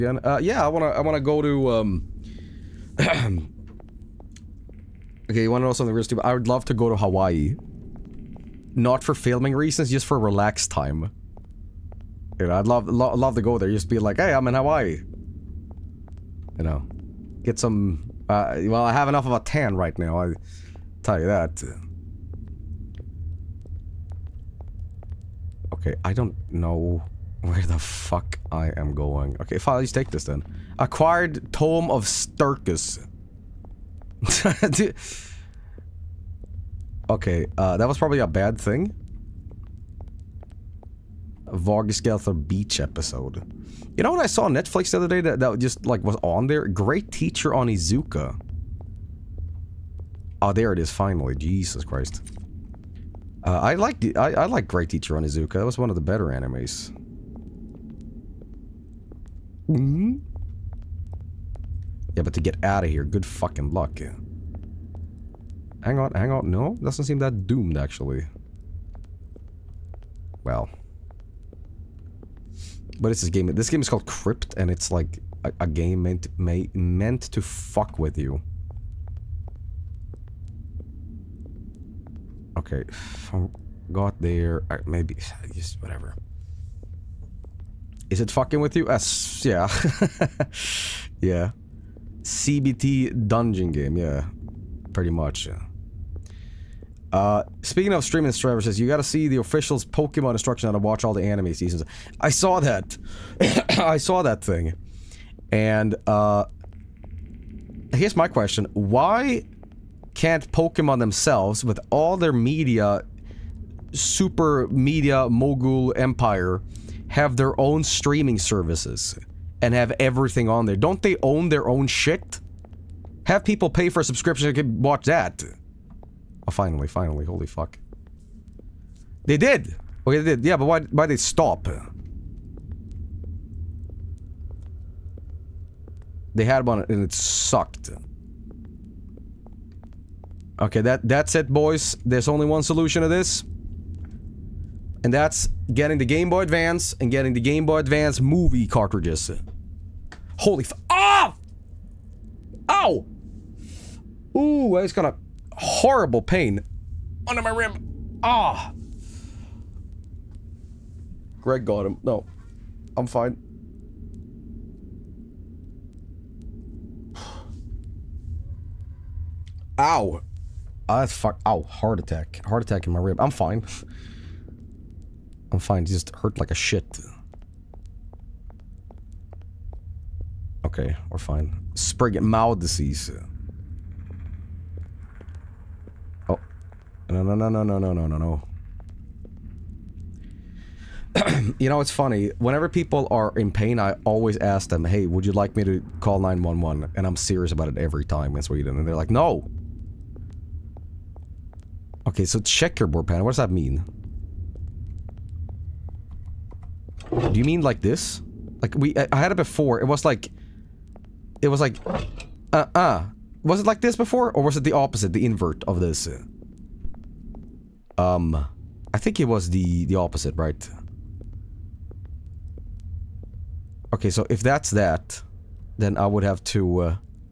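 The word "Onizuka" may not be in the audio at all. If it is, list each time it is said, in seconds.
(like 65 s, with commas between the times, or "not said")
47 s, 55 s.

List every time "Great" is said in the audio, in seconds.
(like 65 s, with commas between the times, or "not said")
46 s, 54 s.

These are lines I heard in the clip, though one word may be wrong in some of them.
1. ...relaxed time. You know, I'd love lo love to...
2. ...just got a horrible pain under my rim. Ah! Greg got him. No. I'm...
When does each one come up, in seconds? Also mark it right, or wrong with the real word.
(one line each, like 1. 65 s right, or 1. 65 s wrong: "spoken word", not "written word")
1. 10 s right
2. 154 s right.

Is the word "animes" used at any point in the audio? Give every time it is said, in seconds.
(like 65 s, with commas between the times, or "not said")
56 s, 101 s.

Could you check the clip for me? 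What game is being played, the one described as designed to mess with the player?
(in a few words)
Crypt.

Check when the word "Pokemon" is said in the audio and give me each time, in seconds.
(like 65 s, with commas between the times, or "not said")
99 s, 110 s.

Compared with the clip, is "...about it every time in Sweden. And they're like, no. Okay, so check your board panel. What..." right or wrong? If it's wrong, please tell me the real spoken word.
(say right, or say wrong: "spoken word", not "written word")
right.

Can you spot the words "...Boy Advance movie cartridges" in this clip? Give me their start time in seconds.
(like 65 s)
147 s.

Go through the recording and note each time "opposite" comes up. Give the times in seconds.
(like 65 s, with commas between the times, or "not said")
214 s, 219 s.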